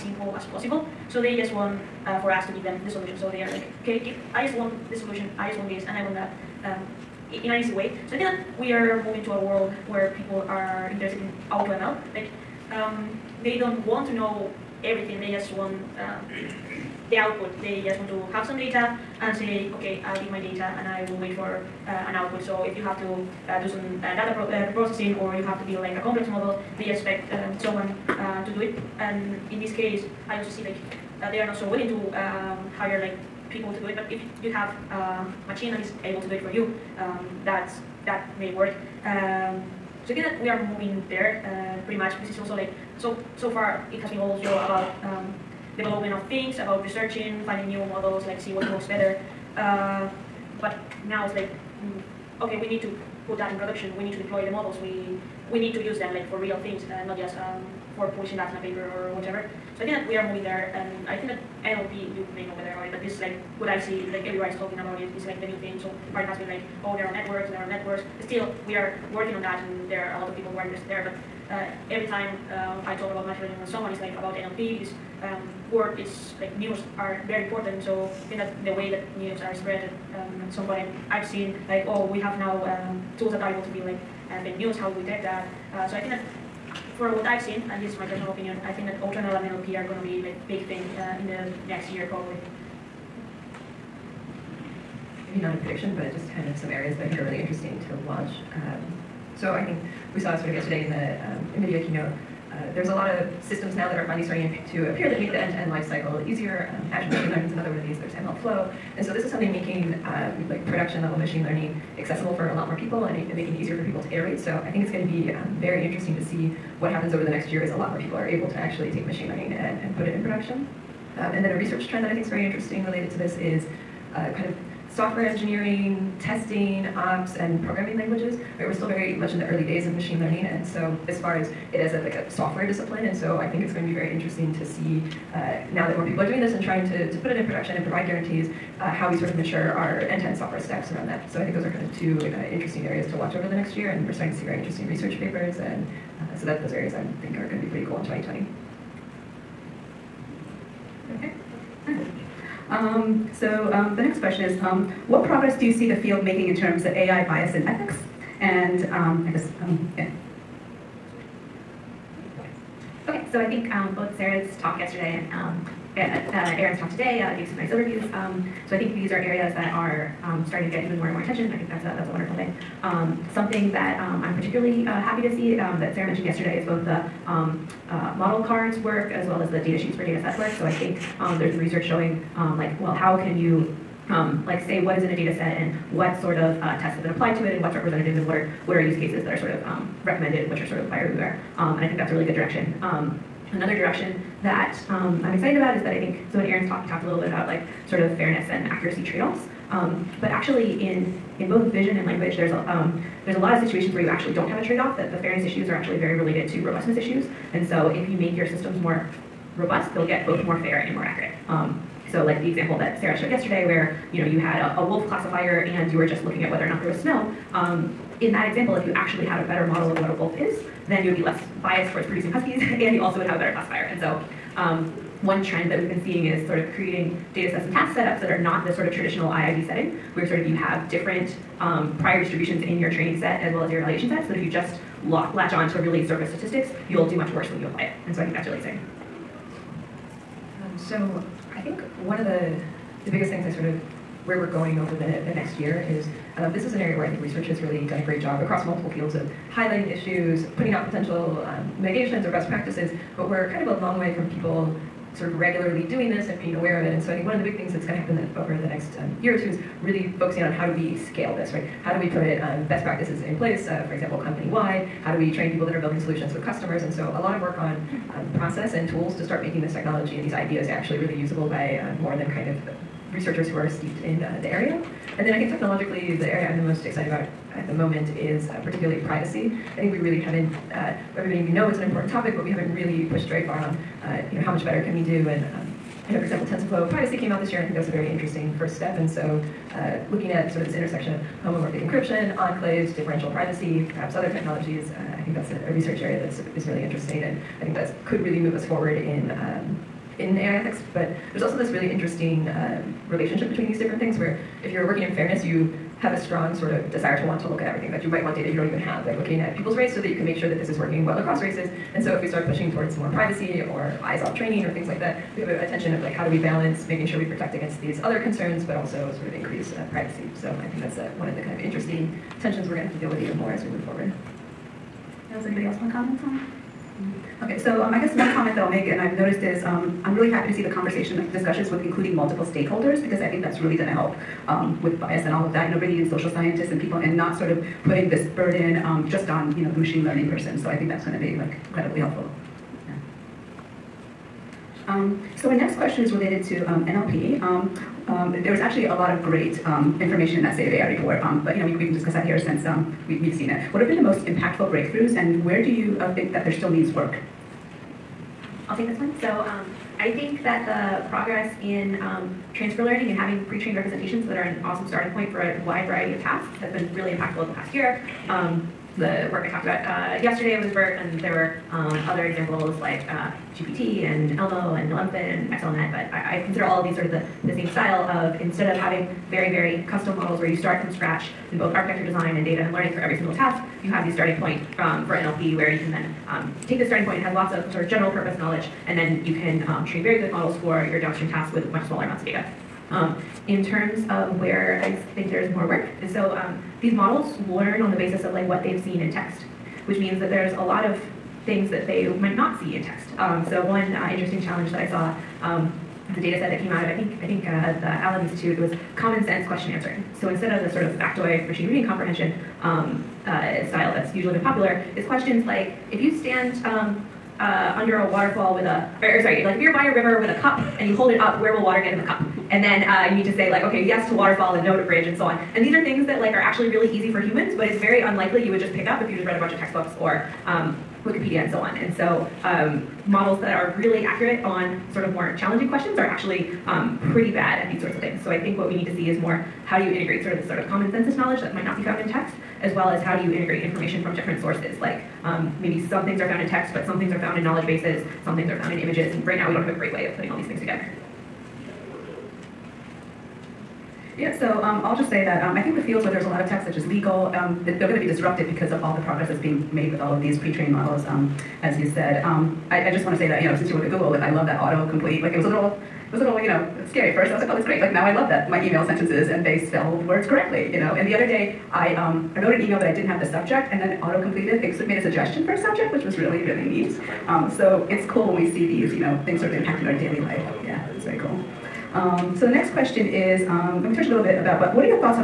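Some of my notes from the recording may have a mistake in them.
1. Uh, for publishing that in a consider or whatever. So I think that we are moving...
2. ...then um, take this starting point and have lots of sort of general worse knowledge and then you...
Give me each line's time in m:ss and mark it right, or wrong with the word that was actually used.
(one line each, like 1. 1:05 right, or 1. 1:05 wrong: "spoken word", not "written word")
1. 0:57 wrong: "paper", not "consider"
2. 6:25 wrong: "purpose", not "worse".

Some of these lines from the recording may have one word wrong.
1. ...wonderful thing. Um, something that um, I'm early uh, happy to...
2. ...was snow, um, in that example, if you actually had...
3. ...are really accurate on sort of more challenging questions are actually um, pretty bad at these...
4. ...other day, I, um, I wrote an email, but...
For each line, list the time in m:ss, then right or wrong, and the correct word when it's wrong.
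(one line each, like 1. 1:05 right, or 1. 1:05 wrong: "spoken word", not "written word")
1. 2:52 wrong: "particularly", not "early"
2. 3:36 right
3. 7:13 right
4. 7:51 right.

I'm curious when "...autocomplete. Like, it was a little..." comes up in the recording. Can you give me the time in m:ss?
7:44.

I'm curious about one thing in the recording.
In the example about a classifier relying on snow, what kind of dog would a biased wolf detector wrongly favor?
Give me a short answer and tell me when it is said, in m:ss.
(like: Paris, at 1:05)
huskies, at 3:42.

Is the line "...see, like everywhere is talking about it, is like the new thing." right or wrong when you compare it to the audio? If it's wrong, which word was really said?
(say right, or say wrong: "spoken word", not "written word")
right.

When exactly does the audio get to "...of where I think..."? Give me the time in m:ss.
6:34.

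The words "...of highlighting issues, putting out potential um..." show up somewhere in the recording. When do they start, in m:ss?
4:09.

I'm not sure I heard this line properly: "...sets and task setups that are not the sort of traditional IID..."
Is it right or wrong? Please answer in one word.
right.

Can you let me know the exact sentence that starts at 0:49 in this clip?
Uh, but now it's like mm, okay, we need to put that in production.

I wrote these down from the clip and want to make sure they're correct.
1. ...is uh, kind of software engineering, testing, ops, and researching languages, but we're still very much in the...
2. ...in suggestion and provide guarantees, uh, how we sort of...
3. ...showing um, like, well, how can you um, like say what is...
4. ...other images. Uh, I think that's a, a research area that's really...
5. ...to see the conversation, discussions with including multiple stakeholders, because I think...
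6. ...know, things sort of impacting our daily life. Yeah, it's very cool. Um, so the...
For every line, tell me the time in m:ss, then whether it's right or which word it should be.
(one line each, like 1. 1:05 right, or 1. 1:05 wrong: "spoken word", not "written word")
1. 2:03 wrong: "programming", not "researching"
2. 2:17 wrong: "production", not "suggestion"
3. 3:01 right
4. 4:54 wrong: "technologies", not "images"
5. 5:30 right
6. 7:58 right.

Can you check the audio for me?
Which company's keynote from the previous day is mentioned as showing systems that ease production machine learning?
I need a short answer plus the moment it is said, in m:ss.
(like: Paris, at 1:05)
NVIDIA, at 1:41.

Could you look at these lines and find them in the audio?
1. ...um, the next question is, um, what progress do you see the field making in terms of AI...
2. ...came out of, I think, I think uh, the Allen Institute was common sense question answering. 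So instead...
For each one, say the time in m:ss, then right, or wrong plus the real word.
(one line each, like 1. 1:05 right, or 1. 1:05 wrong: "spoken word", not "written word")
1. 2:33 right
2. 6:46 right.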